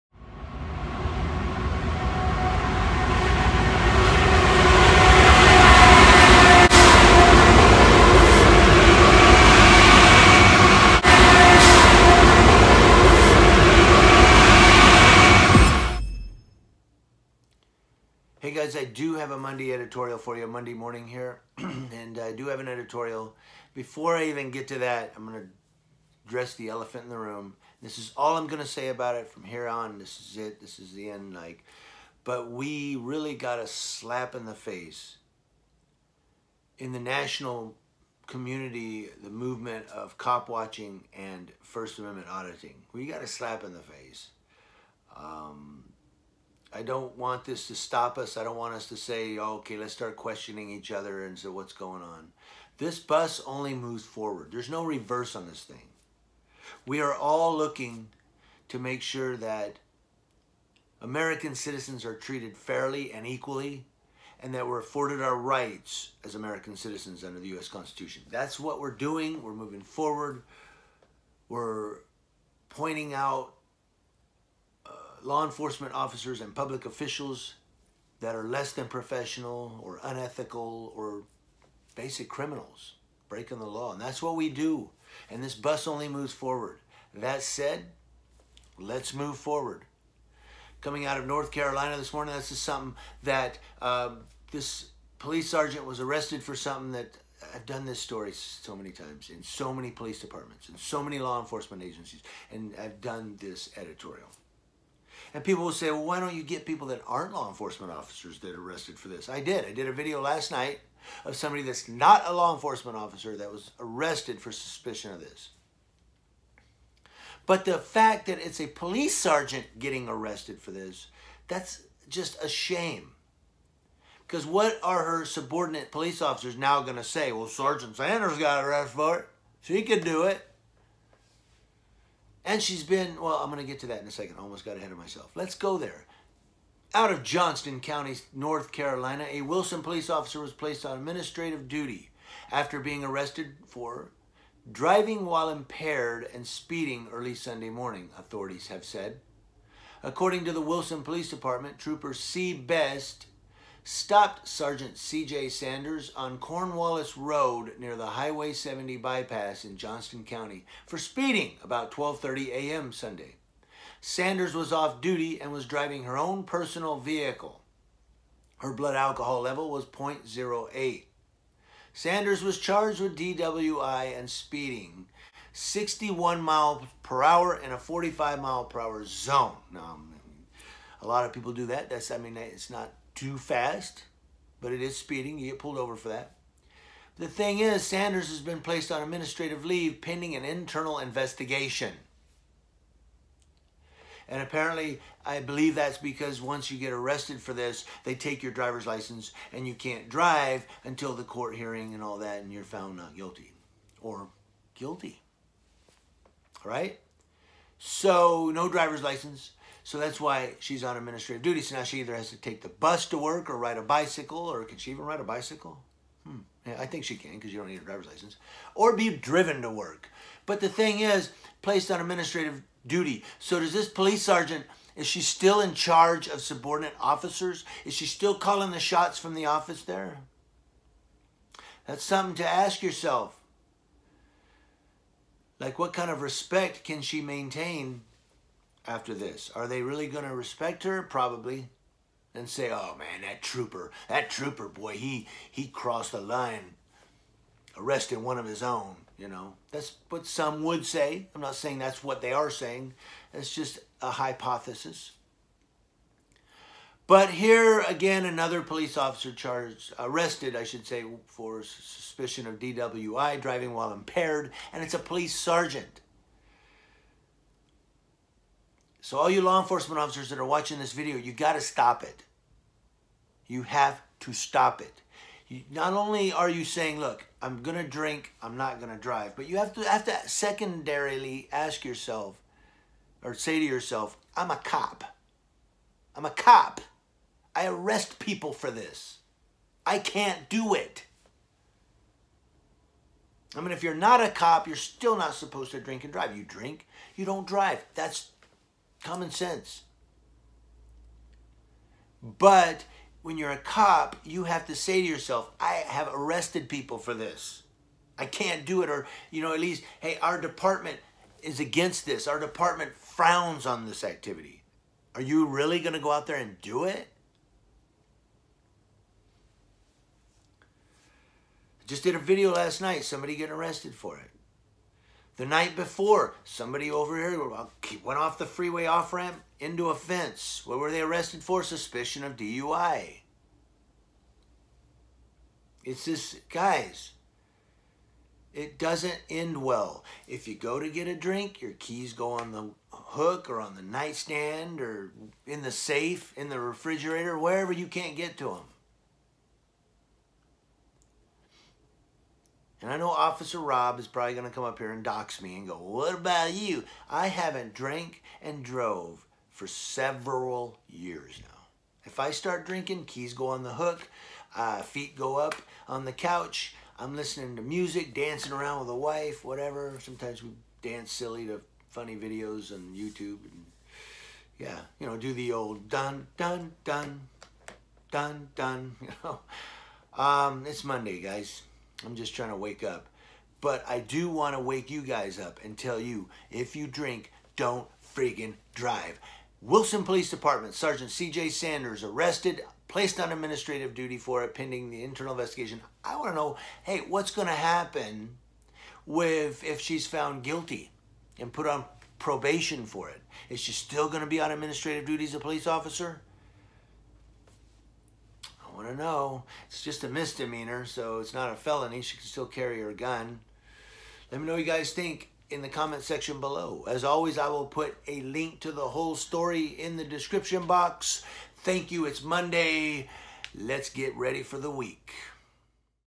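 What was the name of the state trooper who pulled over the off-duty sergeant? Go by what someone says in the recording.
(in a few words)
C. Best.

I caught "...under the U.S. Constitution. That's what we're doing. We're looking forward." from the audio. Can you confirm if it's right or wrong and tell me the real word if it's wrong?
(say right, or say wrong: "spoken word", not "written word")
wrong: "moving", not "looking".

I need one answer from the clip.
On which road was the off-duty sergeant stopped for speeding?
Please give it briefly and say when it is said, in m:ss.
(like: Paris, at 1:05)
Cornwallis Road, at 2:36.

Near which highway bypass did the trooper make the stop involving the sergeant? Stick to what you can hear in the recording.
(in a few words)
Highway 70.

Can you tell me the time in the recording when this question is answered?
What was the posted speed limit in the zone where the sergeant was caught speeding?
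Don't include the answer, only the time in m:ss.
2:57.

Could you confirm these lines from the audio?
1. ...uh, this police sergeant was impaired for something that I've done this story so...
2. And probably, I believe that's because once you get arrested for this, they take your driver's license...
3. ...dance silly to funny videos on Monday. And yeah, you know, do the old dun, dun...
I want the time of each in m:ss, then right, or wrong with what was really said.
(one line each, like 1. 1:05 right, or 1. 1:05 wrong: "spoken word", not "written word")
1. 1:33 wrong: "arrested", not "impaired"
2. 3:14 wrong: "apparently", not "probably"
3. 6:10 wrong: "YouTube", not "Monday".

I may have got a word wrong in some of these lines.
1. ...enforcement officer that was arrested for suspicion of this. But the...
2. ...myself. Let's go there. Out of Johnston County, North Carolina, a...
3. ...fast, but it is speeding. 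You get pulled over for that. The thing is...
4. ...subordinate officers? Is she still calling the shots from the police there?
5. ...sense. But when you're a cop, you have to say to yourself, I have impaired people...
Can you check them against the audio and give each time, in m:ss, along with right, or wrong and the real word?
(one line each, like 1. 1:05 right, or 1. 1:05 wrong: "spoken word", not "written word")
1. 1:52 right
2. 2:14 right
3. 3:03 right
4. 3:46 wrong: "office", not "police"
5. 4:59 wrong: "arrested", not "impaired".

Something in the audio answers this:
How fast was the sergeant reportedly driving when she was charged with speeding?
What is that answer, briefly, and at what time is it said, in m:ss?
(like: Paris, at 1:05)
61 mph, at 2:55.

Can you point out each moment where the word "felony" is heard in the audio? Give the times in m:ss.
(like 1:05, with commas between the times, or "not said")
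6:51.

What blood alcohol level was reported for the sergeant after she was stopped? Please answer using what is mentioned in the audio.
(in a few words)
0.08.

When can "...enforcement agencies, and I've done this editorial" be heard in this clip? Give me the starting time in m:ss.
1:41.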